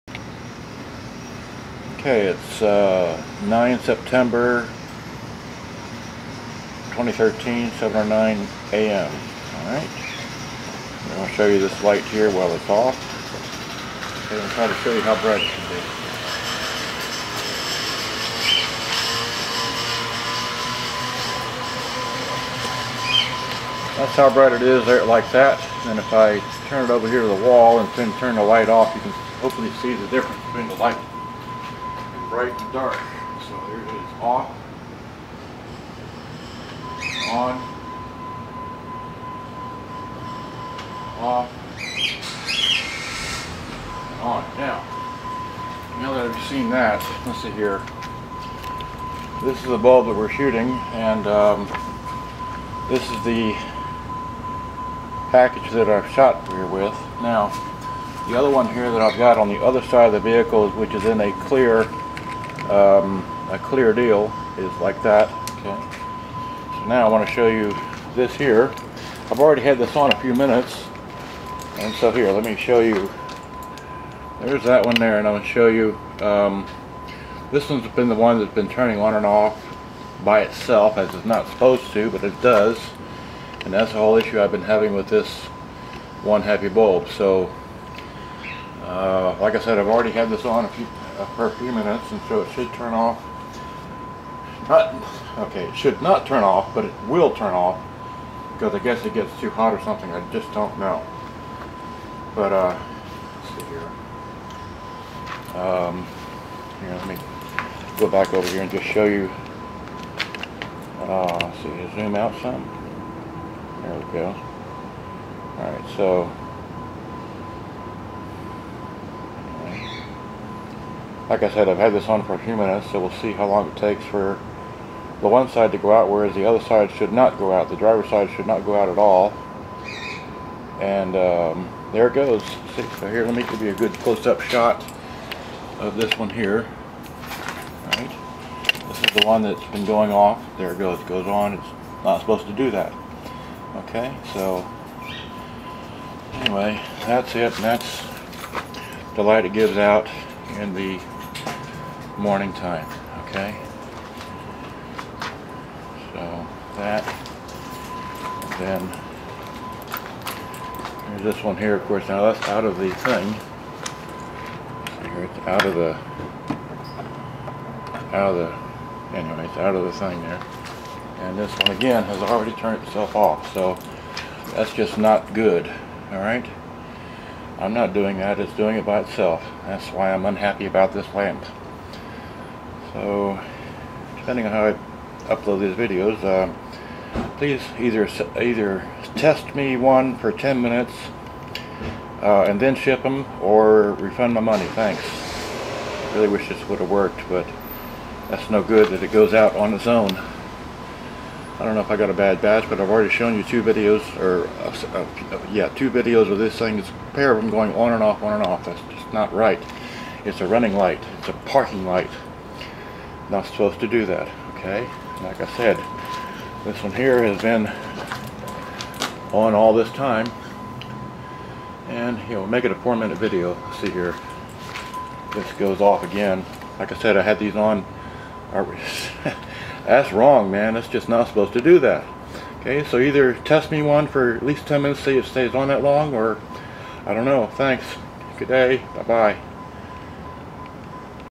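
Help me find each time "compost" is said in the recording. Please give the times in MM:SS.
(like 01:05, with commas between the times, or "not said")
not said.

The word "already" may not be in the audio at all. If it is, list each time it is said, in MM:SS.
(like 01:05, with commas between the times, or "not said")
01:09, 01:29, 02:52, 03:22.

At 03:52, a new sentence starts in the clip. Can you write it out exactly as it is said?
Okay, so either test me one for at least 10 minutes, see if it stays on that long, or I don't know.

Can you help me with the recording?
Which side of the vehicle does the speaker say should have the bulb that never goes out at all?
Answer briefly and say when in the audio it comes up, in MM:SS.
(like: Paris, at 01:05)
Driver's side, at 02:07.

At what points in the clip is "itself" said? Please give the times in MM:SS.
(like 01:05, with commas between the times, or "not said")
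01:20, 02:52, 02:58.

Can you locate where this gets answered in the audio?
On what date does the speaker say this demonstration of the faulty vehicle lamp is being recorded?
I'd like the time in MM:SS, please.
00:03.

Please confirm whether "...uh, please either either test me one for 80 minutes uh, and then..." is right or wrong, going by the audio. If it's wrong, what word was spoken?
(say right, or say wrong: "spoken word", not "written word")
wrong: "10", not "80".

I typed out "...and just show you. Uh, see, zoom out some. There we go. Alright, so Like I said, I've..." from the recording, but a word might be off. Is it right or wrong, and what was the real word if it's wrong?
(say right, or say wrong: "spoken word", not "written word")
right.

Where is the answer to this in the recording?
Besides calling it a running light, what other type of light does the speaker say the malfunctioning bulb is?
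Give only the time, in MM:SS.
03:31.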